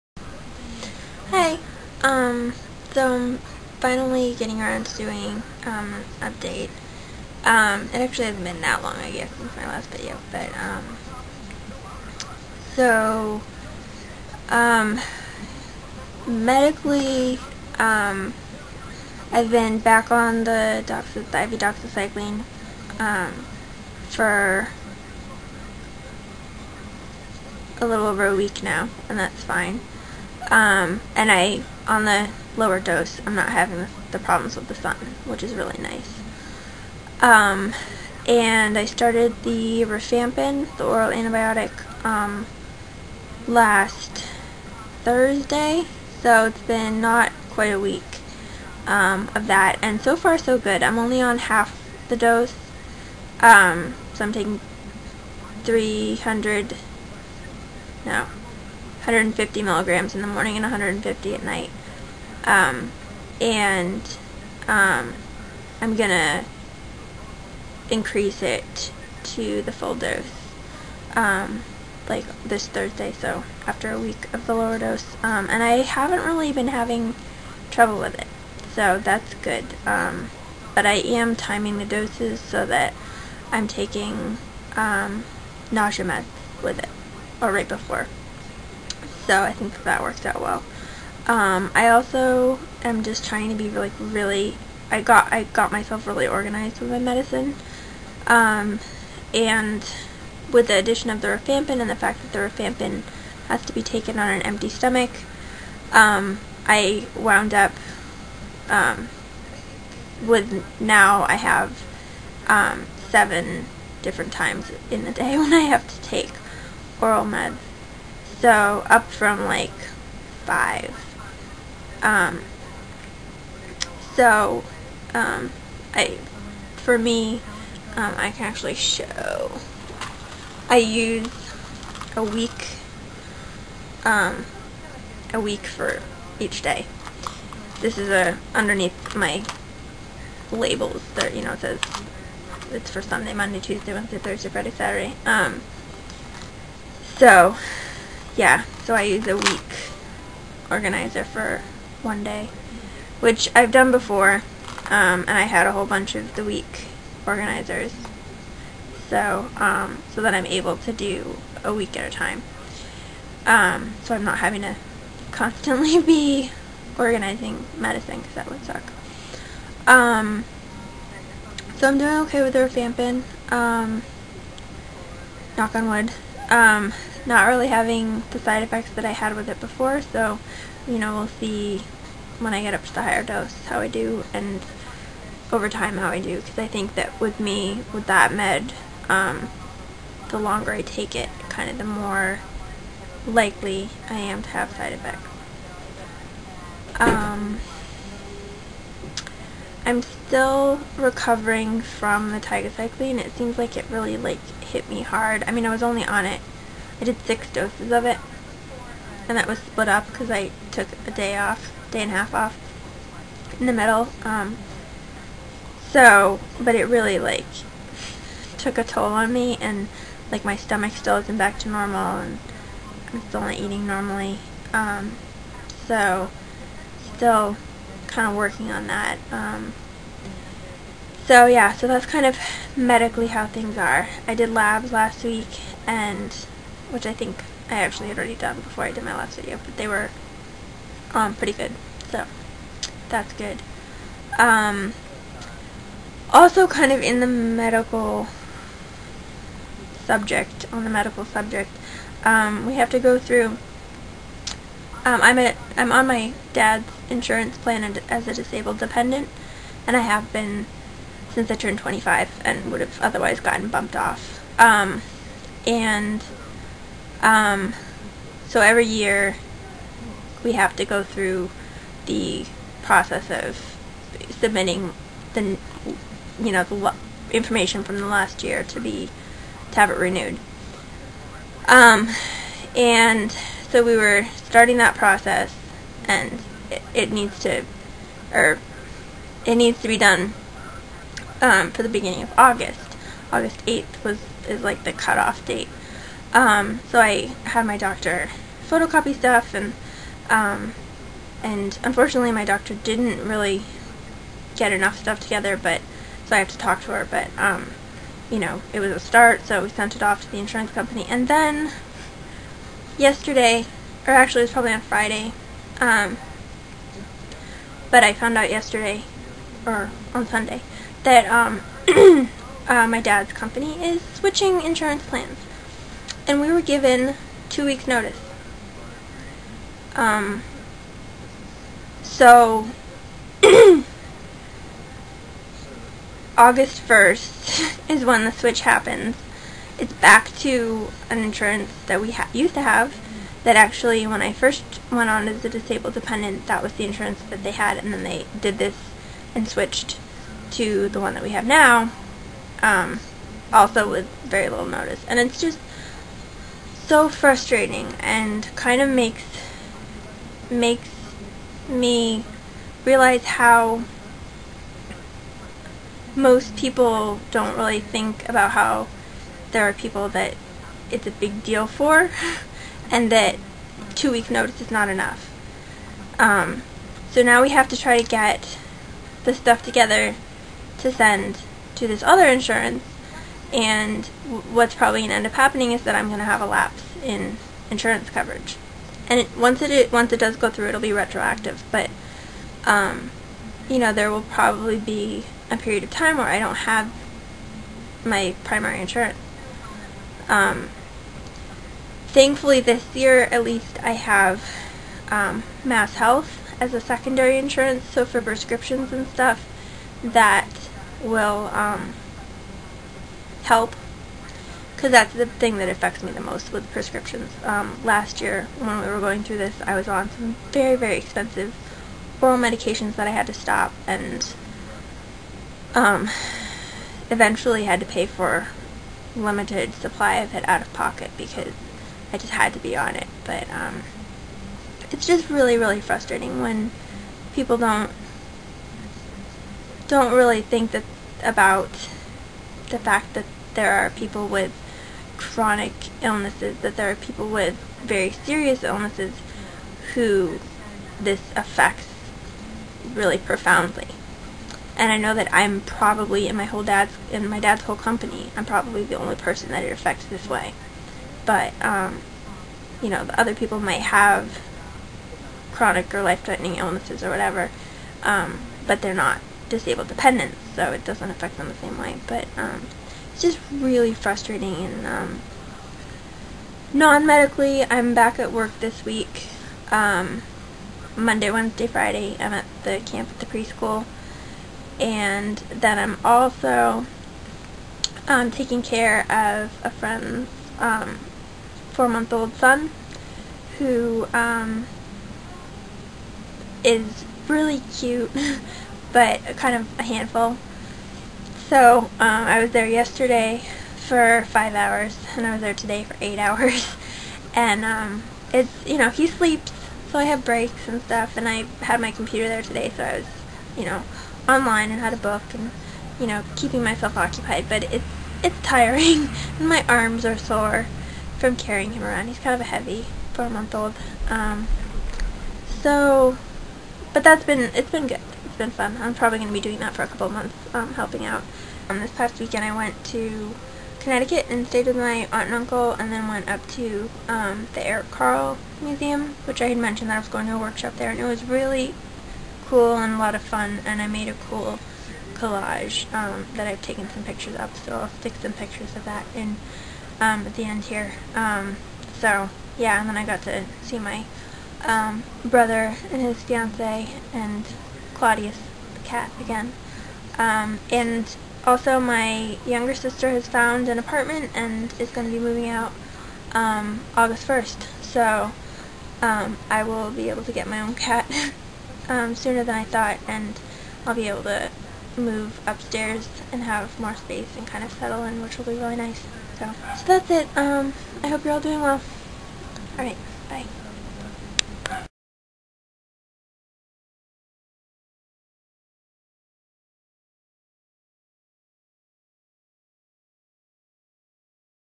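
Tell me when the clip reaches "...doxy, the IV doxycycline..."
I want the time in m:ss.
0:20.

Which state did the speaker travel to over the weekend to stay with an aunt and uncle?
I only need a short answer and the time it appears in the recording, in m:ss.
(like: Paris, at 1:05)
Connecticut, at 8:53.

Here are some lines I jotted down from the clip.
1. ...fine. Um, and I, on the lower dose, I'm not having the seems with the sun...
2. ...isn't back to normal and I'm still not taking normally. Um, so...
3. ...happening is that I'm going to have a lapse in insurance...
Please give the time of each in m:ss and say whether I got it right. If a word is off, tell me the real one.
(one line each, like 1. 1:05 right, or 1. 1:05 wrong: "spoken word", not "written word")
1. 0:29 wrong: "problems", not "seems"
2. 3:41 wrong: "eating", not "taking"
3. 6:25 right.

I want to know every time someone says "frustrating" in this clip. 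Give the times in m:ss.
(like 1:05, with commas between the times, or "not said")
5:57, 7:15, 7:53.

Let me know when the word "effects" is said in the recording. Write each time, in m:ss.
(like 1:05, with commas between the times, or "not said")
2:58, 3:14.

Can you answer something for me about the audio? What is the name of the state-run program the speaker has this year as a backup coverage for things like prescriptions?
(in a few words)
Mass Health.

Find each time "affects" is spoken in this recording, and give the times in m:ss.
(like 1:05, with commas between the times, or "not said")
6:55, 7:31, 7:39, 7:51.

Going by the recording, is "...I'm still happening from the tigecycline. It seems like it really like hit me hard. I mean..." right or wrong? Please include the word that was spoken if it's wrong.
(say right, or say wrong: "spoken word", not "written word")
wrong: "recovering", not "happening".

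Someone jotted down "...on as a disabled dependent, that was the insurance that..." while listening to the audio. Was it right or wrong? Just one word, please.
right.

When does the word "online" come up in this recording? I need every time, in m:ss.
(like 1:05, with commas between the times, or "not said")
8:34.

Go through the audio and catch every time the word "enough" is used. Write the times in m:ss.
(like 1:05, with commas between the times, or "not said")
5:04, 6:14.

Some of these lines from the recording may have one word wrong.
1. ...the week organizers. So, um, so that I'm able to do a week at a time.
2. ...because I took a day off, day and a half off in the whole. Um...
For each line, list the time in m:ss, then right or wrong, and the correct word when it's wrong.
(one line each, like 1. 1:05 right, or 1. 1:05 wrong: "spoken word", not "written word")
1. 2:36 right
2. 3:30 wrong: "middle", not "whole".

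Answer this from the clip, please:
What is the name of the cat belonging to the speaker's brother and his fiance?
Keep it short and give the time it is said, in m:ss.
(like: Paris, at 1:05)
Claudius, at 9:17.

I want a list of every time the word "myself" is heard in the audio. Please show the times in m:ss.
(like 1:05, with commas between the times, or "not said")
1:35, 8:36.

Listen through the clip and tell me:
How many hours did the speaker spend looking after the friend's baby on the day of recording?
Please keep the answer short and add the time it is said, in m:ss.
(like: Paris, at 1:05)
8, at 8:26.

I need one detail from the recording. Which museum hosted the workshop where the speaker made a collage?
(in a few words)
Eric Carle Museum.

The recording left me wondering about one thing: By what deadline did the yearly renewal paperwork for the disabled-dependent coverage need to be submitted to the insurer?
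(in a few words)
August 8th.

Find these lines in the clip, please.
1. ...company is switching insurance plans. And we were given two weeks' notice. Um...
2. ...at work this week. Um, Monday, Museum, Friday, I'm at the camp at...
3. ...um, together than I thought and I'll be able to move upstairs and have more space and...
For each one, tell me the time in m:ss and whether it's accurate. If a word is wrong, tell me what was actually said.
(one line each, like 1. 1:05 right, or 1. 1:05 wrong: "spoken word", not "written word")
1. 5:23 right
2. 7:58 wrong: "Wednesday", not "Museum"
3. 9:31 wrong: "sooner", not "together".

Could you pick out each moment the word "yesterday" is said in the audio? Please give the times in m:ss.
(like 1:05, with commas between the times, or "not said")
5:13, 5:18, 8:22.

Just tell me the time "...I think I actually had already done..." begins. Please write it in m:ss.
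3:57.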